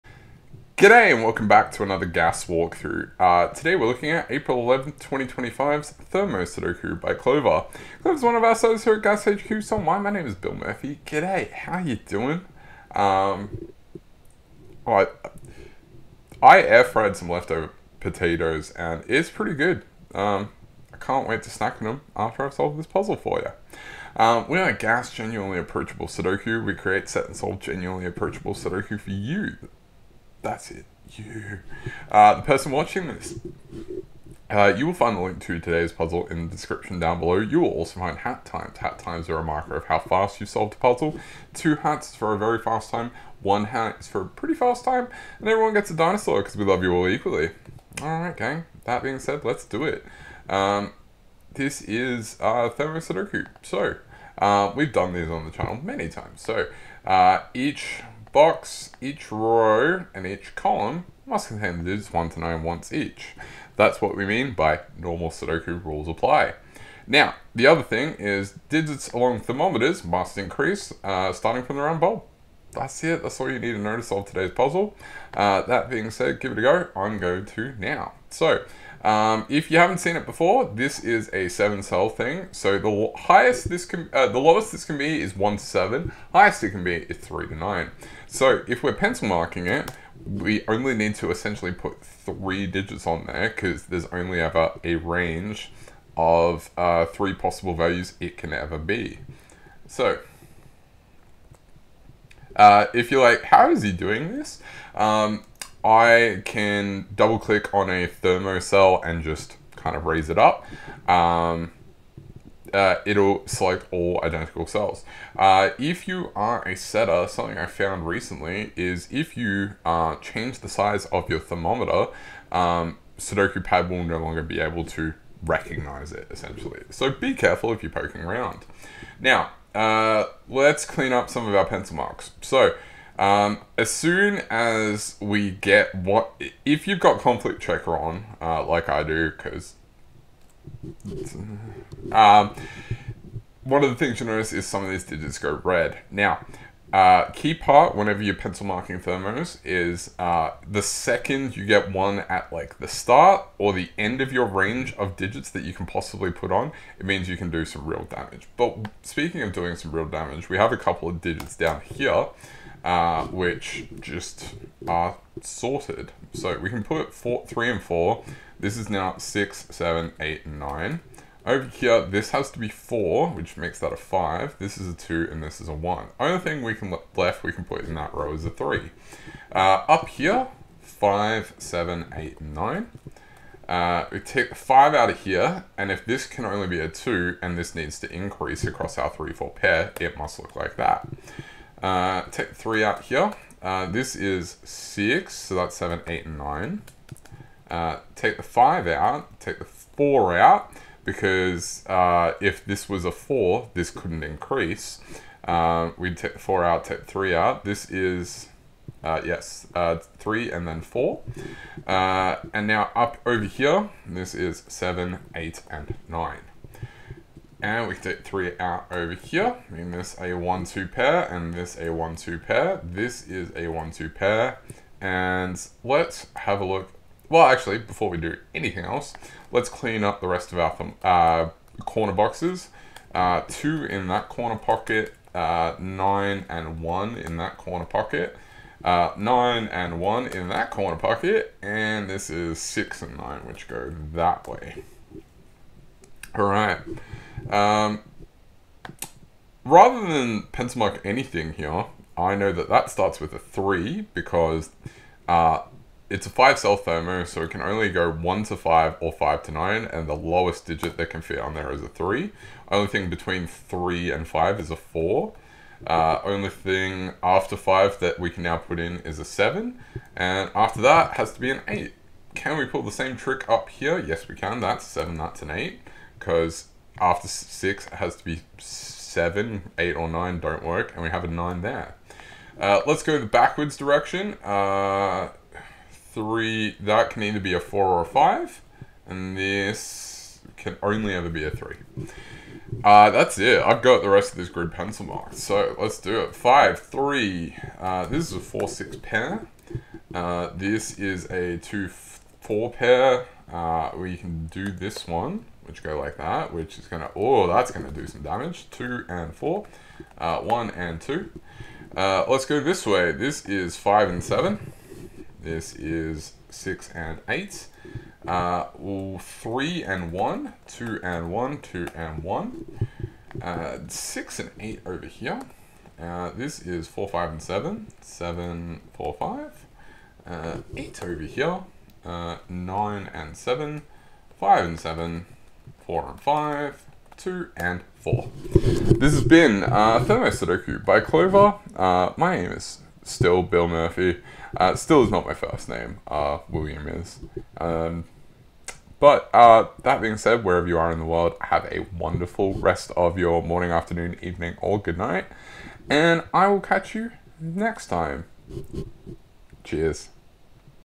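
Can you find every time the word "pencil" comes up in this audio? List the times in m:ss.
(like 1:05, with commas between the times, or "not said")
1:28, 2:11, 2:28, 4:10, 4:54.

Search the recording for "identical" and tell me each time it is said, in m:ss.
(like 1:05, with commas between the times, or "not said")
1:54.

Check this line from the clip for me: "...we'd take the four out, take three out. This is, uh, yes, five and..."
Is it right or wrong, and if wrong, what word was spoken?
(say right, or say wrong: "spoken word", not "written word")
wrong: "three", not "five".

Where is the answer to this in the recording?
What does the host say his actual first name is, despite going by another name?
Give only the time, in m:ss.
5:46.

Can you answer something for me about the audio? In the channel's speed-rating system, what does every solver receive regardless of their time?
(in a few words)
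a dinosaur.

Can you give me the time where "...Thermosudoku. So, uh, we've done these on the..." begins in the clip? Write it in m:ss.
0:52.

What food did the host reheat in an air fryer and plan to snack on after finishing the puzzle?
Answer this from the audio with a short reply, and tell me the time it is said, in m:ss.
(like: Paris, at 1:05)
leftover potatoes, at 0:17.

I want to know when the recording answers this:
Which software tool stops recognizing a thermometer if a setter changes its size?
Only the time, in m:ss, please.
2:03.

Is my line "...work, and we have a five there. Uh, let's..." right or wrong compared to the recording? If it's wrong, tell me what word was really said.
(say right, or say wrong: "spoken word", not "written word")
wrong: "nine", not "five".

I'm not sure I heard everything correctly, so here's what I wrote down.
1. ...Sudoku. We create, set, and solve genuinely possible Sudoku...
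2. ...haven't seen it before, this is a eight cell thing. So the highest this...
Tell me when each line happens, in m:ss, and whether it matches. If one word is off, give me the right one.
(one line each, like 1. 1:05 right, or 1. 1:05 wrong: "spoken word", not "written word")
1. 0:26 wrong: "approachable", not "possible"
2. 1:19 wrong: "seven", not "eight".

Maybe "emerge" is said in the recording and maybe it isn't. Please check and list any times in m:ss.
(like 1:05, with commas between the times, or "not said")
not said.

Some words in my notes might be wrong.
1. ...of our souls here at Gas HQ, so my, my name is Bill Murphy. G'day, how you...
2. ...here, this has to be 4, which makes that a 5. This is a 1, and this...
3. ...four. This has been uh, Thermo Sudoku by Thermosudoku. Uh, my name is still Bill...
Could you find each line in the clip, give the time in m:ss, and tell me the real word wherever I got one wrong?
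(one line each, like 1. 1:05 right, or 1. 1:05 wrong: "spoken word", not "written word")
1. 0:08 right
2. 2:51 wrong: "2", not "1"
3. 5:37 wrong: "Clover", not "Thermosudoku".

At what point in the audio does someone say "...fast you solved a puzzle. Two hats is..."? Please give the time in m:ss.
0:39.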